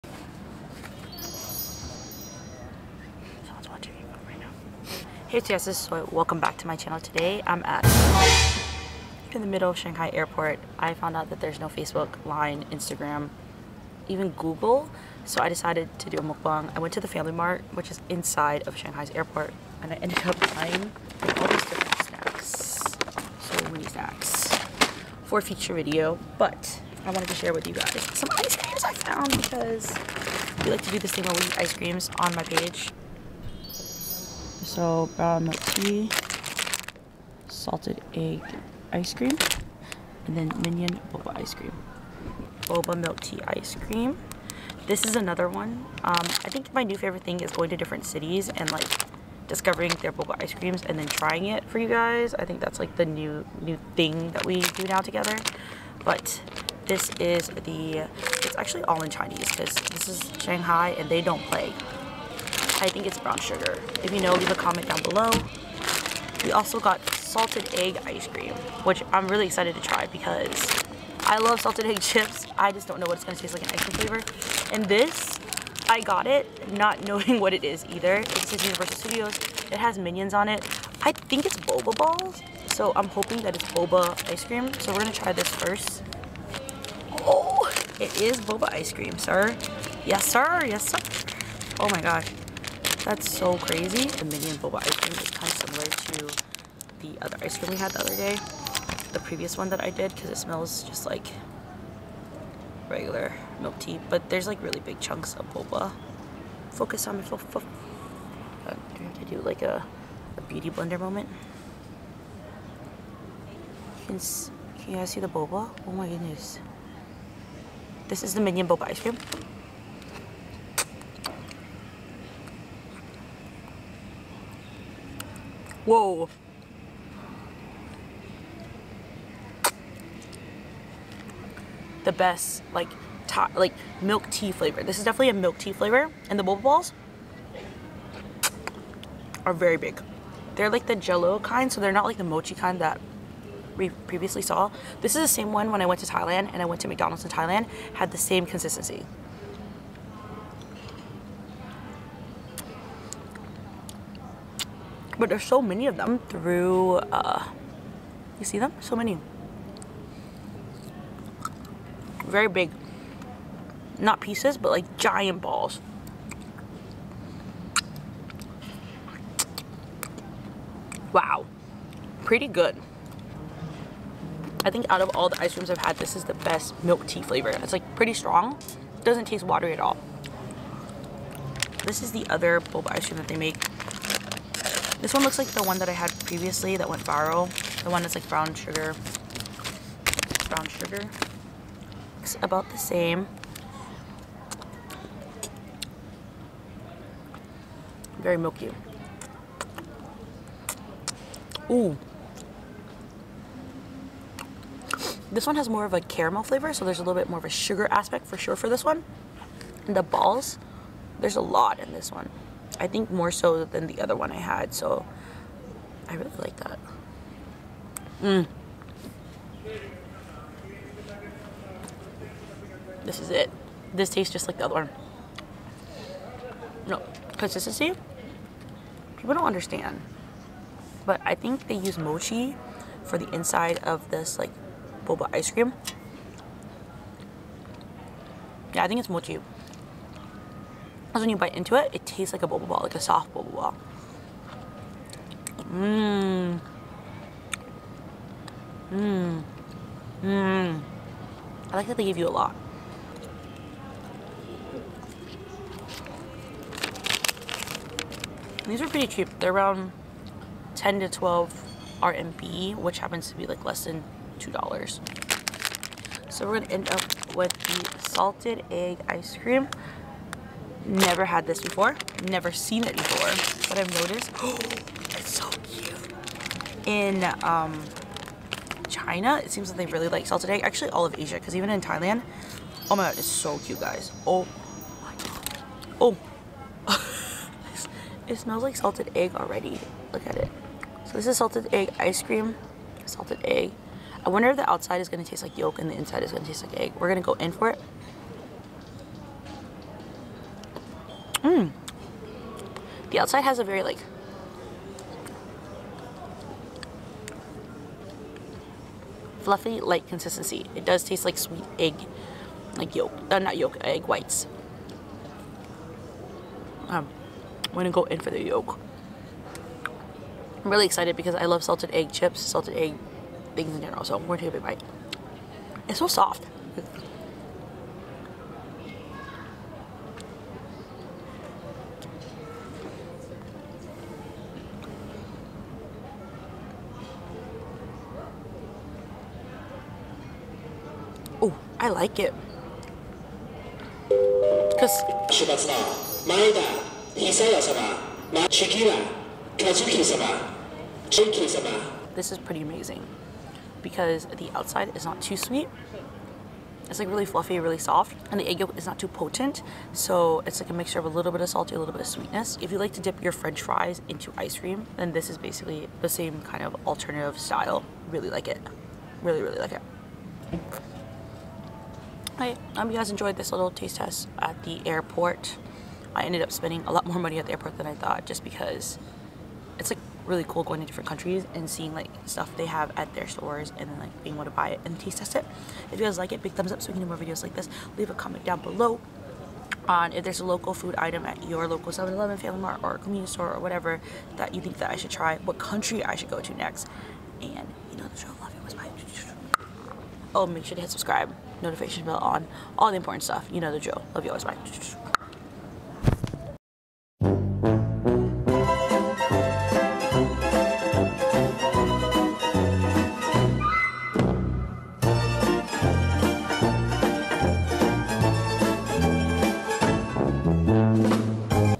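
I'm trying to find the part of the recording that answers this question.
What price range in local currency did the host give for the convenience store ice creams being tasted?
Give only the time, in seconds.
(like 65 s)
260 s.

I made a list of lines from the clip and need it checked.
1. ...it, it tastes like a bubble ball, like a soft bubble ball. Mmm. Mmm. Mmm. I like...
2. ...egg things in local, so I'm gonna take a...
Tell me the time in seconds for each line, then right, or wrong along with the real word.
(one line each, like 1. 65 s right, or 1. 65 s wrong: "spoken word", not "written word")
1. 241 s right
2. 322 s wrong: "general", not "local".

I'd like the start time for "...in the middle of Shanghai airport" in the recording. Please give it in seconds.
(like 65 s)
9 s.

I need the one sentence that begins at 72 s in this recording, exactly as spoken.
I just don't know what it's gonna taste like in ice cream flavor.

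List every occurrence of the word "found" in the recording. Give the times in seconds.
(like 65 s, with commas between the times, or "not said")
10 s, 28 s.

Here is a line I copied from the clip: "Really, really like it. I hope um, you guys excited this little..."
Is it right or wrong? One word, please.
wrong.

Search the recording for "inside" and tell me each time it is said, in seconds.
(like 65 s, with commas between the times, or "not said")
18 s, 233 s, 295 s.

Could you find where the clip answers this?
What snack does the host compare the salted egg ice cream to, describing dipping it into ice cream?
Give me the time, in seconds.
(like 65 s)
363 s.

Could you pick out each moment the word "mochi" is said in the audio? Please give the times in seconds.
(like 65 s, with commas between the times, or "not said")
142 s, 231 s, 239 s.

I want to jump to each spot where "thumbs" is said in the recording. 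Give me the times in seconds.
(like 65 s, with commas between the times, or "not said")
386 s.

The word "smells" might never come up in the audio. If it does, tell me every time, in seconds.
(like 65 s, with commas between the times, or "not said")
100 s, 288 s.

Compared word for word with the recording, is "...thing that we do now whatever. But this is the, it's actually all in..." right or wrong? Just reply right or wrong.
wrong.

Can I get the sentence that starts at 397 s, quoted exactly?
And you know the show, love it, was my...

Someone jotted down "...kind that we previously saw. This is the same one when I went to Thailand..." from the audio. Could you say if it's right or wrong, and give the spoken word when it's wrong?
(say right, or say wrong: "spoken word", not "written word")
right.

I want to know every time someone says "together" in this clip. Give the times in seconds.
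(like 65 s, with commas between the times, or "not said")
54 s.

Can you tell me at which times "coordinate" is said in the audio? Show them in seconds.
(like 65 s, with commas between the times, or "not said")
not said.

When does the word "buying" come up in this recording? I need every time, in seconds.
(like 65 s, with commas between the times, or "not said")
20 s.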